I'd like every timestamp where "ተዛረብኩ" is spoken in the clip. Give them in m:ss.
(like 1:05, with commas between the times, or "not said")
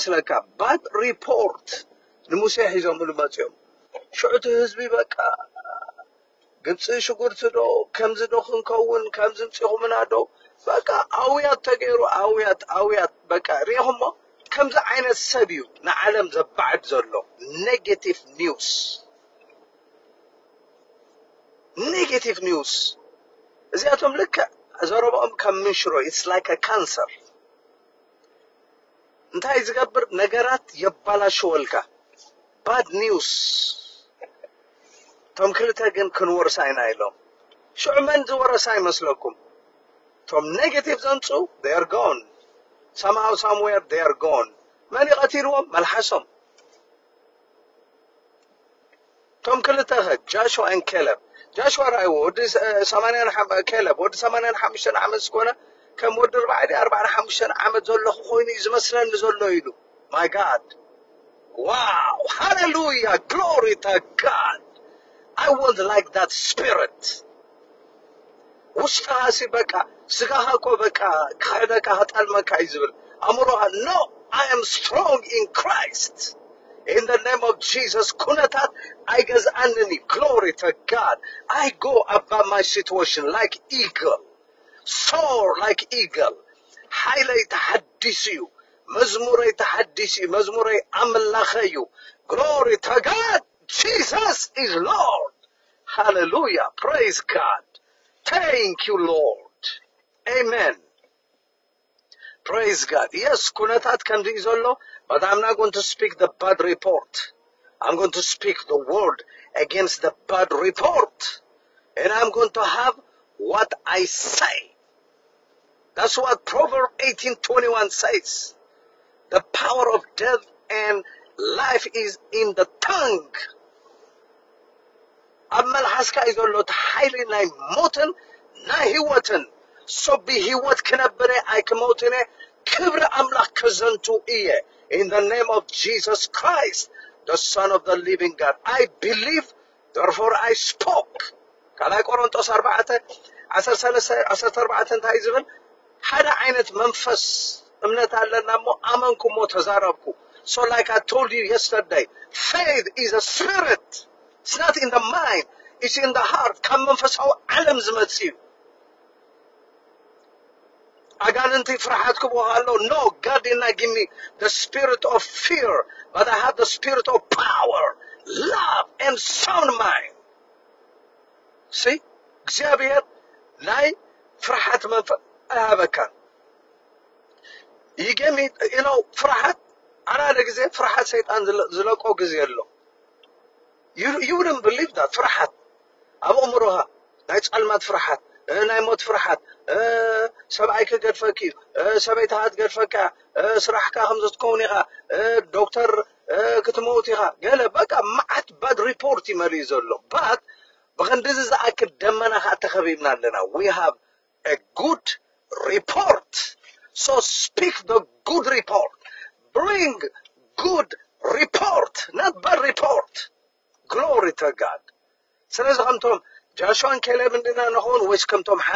2:29.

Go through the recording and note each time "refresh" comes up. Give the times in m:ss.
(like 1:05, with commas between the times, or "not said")
not said.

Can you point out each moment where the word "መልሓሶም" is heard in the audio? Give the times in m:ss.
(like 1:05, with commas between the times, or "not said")
0:45.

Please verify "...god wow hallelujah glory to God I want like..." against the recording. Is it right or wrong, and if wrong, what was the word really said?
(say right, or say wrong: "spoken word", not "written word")
right.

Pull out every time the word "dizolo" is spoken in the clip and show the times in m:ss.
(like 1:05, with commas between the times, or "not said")
1:44.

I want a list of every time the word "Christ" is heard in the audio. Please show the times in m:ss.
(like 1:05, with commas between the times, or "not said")
1:15, 2:16.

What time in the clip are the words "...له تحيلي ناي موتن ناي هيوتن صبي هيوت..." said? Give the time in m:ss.
2:06.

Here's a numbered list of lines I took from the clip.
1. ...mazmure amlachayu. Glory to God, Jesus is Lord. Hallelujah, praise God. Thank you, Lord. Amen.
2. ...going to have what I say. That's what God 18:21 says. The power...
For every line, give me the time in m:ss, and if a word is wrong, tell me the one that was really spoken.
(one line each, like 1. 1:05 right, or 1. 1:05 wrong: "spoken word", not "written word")
1. 1:30 right
2. 1:52 wrong: "Proverbs", not "God".